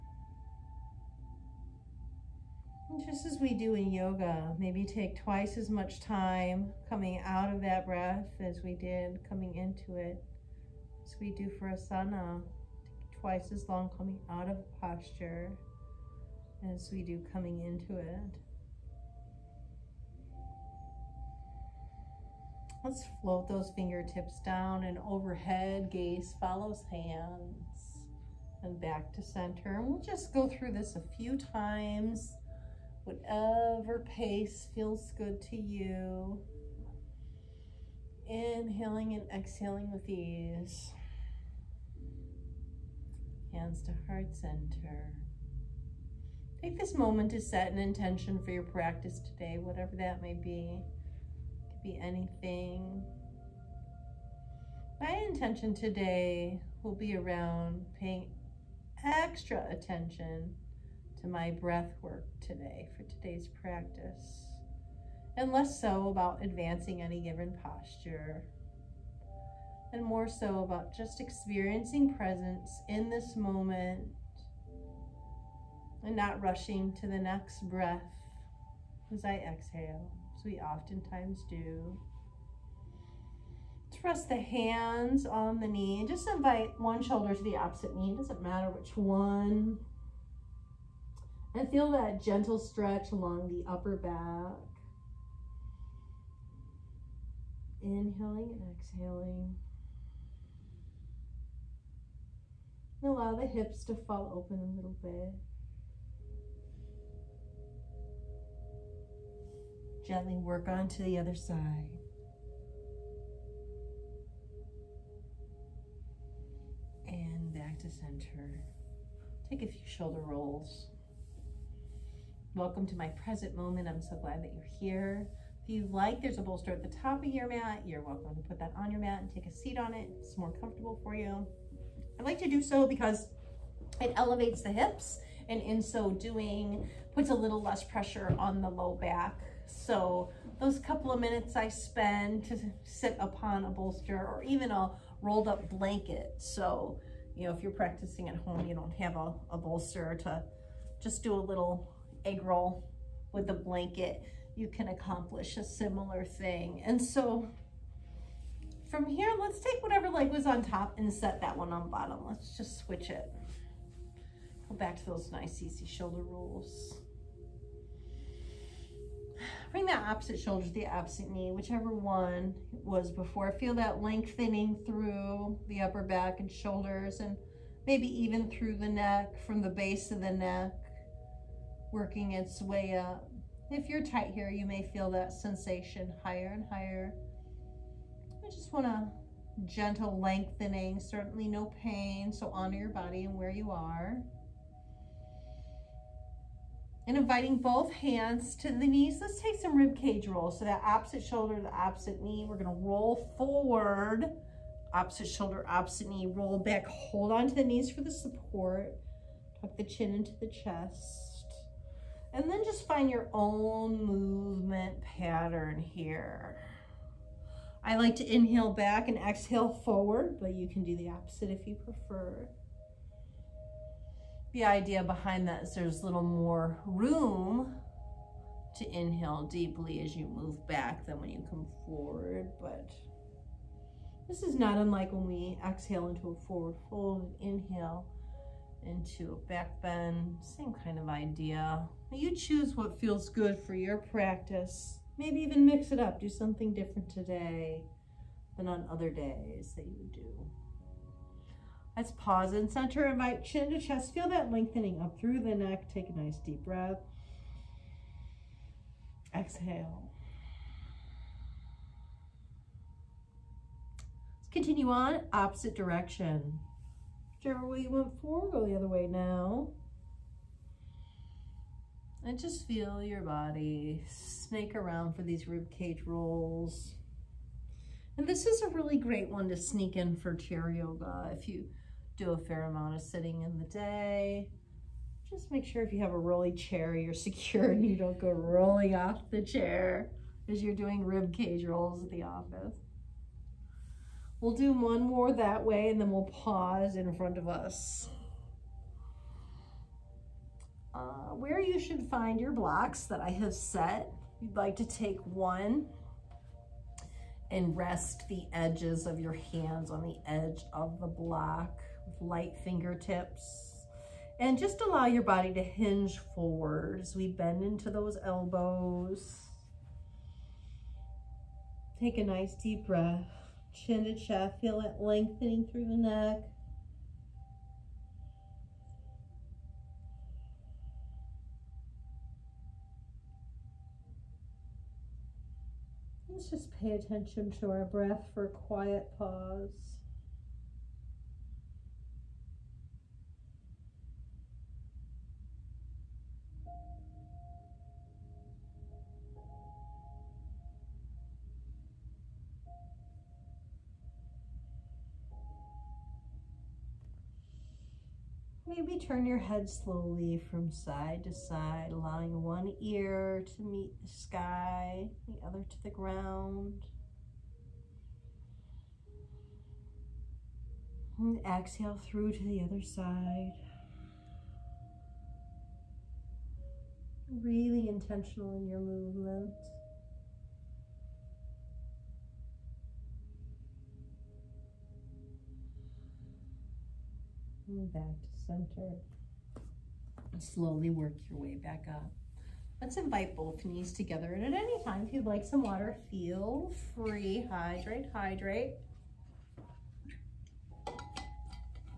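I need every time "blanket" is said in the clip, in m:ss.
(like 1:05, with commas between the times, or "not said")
2:25, 2:33.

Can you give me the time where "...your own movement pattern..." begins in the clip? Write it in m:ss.
3:33.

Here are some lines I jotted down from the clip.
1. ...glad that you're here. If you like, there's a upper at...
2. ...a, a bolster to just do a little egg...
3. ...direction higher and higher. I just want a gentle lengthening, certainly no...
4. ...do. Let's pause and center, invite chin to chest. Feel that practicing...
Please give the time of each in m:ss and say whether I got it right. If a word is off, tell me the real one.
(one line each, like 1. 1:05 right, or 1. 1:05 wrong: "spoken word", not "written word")
1. 2:04 wrong: "bolster", not "upper"
2. 2:29 right
3. 3:05 wrong: "sensation", not "direction"
4. 4:10 wrong: "lengthening", not "practicing".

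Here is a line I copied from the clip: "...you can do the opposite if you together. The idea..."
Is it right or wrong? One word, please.
wrong.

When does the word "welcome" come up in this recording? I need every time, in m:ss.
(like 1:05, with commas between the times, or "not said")
2:02, 2:08.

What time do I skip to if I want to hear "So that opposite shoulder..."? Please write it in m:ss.
3:20.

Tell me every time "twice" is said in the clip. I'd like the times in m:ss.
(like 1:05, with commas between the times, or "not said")
0:05, 0:13.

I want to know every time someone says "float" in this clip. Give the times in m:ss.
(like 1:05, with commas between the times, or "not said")
0:23.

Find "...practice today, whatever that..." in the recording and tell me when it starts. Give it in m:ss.
0:48.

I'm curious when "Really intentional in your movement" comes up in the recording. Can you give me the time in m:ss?
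6:17.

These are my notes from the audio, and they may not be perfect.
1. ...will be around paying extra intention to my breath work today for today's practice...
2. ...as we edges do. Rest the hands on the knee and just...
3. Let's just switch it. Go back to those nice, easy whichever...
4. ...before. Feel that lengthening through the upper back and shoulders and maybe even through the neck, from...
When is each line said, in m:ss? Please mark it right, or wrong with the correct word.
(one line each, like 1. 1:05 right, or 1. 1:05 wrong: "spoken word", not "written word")
1. 0:56 wrong: "attention", not "intention"
2. 1:20 wrong: "oftentimes", not "edges"
3. 2:42 wrong: "shoulder", not "whichever"
4. 2:53 right.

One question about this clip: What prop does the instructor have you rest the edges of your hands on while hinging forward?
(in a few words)
Block.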